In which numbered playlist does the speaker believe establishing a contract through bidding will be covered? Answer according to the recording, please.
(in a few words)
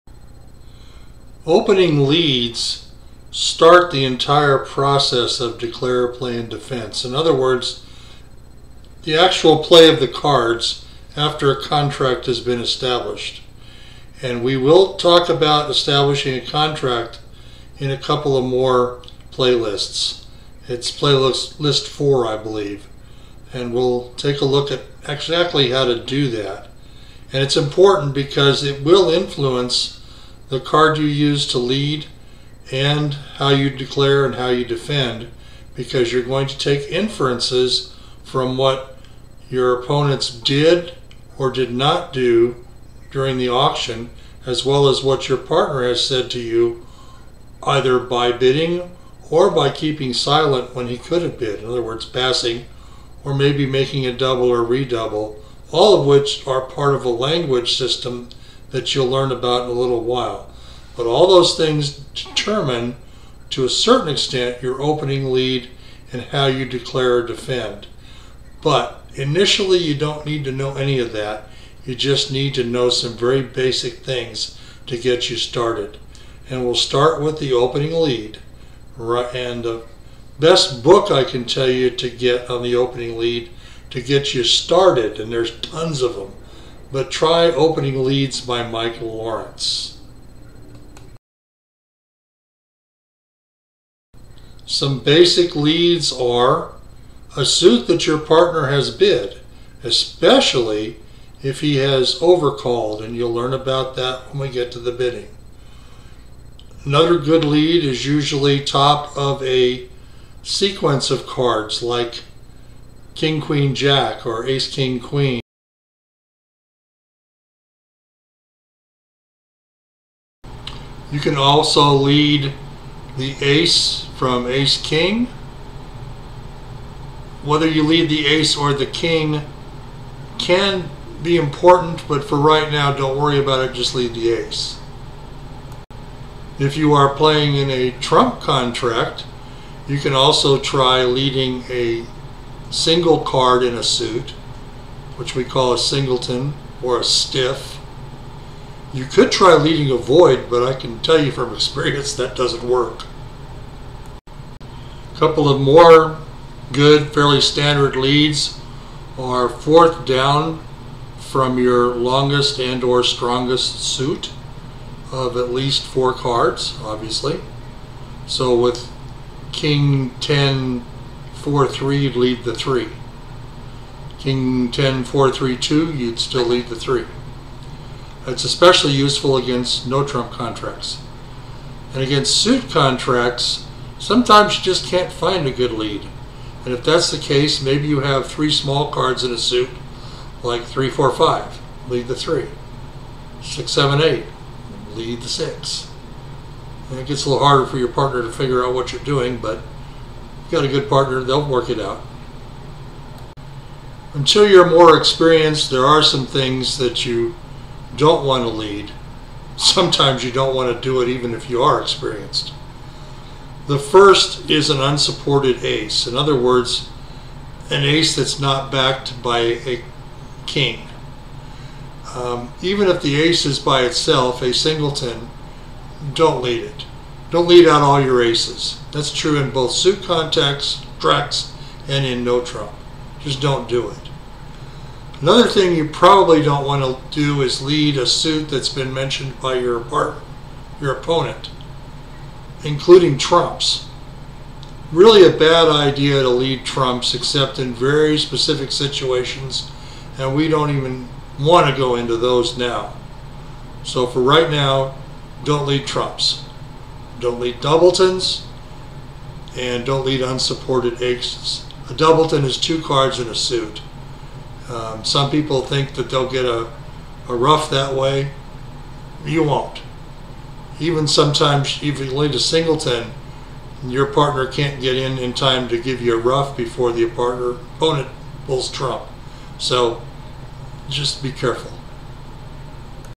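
4.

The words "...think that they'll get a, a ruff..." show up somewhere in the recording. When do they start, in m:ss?
4:25.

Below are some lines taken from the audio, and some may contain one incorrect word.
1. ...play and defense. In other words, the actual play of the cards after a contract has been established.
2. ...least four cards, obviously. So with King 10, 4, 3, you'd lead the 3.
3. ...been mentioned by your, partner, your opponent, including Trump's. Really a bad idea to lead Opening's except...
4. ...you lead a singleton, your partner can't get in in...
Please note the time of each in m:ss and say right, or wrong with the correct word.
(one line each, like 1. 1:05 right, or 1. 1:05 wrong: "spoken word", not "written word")
1. 0:06 right
2. 2:45 right
3. 3:58 wrong: "Trump", not "Opening"
4. 4:31 right.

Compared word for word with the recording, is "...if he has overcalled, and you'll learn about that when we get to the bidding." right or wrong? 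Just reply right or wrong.
right.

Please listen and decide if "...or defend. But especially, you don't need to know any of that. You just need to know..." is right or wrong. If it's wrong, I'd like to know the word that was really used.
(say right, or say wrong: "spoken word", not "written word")
wrong: "initially", not "especially".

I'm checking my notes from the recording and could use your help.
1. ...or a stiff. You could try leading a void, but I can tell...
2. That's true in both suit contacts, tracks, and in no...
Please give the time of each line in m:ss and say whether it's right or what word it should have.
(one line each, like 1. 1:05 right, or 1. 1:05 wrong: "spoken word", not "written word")
1. 2:26 right
2. 3:48 right.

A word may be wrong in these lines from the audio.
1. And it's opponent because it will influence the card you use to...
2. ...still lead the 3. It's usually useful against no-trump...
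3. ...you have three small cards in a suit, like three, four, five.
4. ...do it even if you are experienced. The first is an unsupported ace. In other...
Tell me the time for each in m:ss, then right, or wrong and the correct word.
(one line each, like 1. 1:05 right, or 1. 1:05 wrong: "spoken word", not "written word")
1. 0:27 wrong: "important", not "opponent"
2. 2:56 wrong: "especially", not "usually"
3. 3:07 right
4. 3:30 right.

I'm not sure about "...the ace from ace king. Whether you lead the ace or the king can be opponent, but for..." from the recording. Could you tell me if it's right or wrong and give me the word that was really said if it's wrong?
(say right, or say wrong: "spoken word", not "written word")
wrong: "important", not "opponent".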